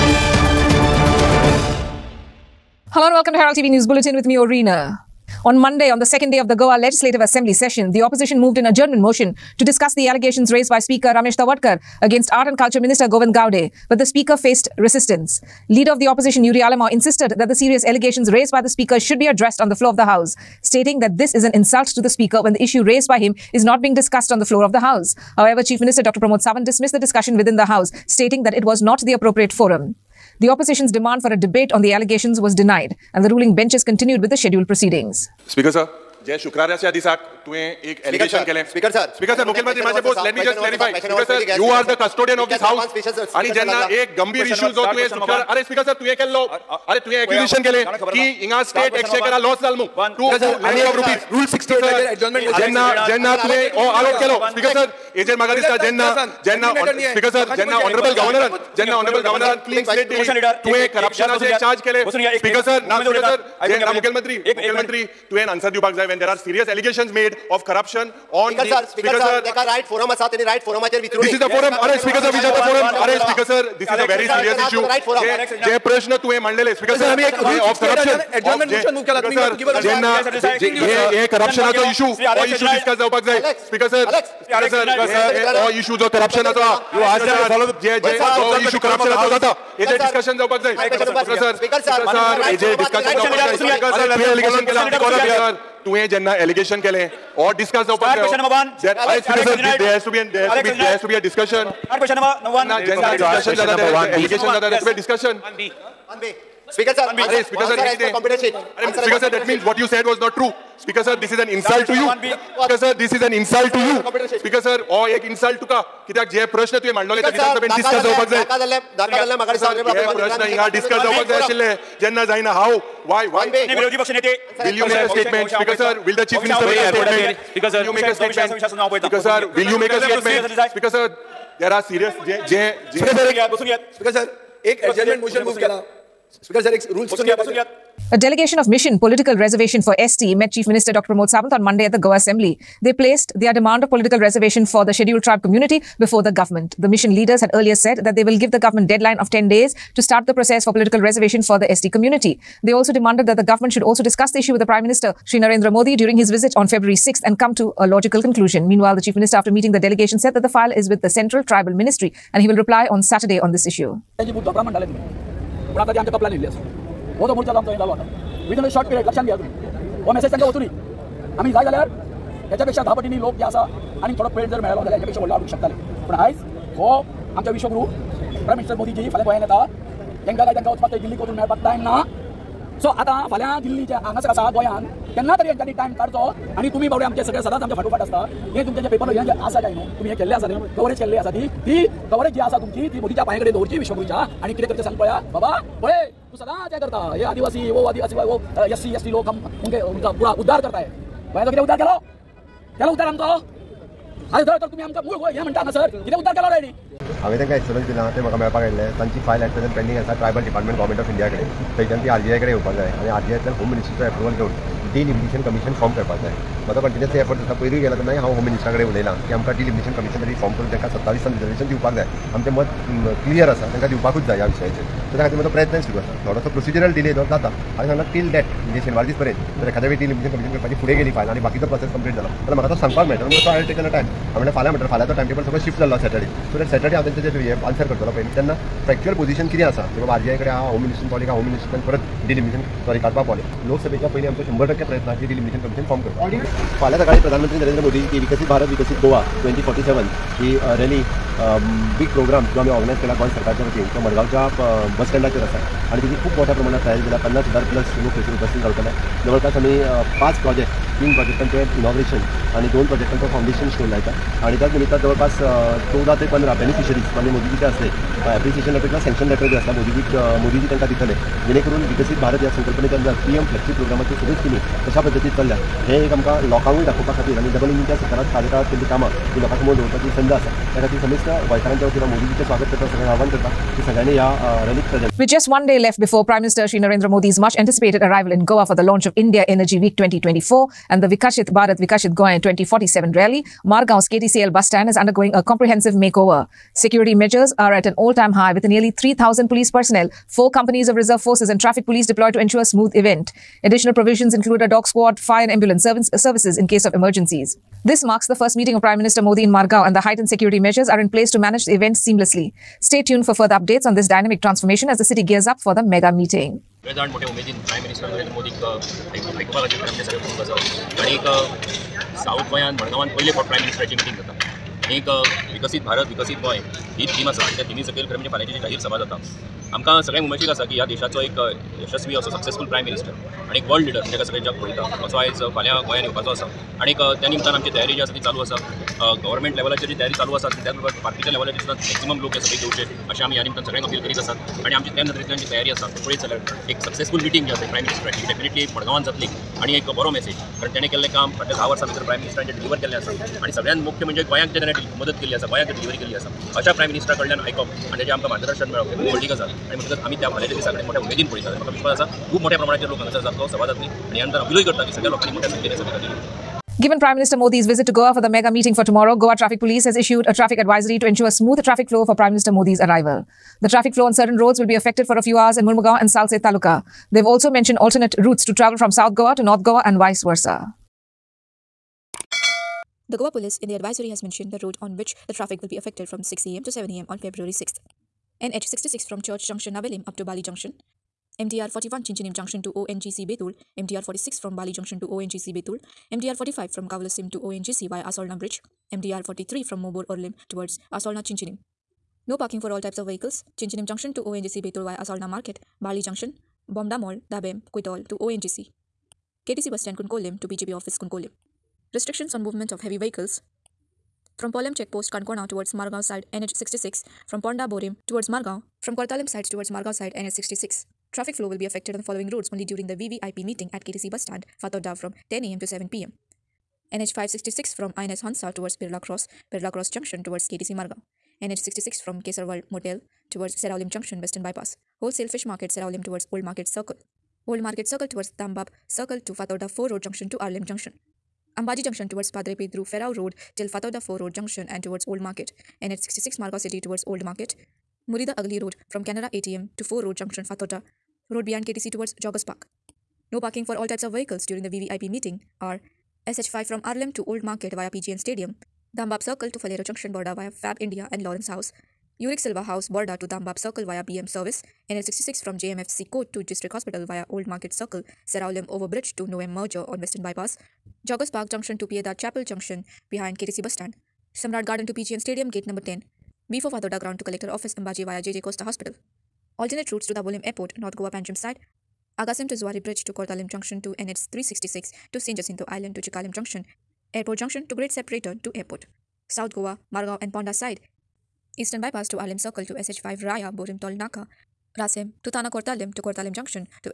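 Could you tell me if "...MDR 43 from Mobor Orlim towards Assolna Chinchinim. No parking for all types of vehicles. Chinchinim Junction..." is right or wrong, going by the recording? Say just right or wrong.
right.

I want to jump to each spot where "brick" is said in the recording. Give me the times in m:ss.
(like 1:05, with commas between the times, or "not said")
not said.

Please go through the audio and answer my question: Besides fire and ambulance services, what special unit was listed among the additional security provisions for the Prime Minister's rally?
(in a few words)
Dog squad.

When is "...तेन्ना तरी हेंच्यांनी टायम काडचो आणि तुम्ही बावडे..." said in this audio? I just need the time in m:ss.
3:05.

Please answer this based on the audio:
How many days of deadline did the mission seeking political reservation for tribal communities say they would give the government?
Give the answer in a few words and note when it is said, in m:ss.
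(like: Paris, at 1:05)
10, at 2:29.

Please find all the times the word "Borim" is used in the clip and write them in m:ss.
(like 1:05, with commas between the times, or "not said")
6:57, 8:13.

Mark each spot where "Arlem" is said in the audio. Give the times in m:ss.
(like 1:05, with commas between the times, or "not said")
7:20, 7:36, 8:12.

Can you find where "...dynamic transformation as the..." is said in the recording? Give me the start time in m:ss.
5:14.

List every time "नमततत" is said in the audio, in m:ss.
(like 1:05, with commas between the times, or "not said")
4:24.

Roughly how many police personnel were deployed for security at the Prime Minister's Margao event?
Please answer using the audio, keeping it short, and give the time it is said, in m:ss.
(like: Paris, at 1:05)
3,000, at 4:58.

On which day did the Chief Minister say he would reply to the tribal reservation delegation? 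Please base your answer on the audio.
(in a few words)
Saturday.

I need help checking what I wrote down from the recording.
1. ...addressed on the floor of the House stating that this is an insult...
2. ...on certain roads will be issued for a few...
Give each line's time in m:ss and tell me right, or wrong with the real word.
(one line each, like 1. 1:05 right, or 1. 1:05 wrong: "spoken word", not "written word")
1. 0:19 right
2. 6:14 wrong: "affected", not "issued".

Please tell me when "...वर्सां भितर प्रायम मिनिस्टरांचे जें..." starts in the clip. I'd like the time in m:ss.
5:51.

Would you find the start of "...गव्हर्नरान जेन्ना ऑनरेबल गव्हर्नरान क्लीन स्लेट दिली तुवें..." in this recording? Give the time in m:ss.
0:58.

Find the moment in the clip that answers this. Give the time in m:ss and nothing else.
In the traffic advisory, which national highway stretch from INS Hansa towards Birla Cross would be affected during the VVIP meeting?
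7:06.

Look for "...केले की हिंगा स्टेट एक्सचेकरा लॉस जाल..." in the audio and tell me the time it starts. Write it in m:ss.
0:47.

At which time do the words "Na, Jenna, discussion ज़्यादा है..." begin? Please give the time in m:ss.
1:42.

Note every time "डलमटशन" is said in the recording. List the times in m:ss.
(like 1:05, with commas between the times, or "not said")
3:50, 4:02.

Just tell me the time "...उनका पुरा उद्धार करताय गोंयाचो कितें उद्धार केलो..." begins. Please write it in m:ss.
3:19.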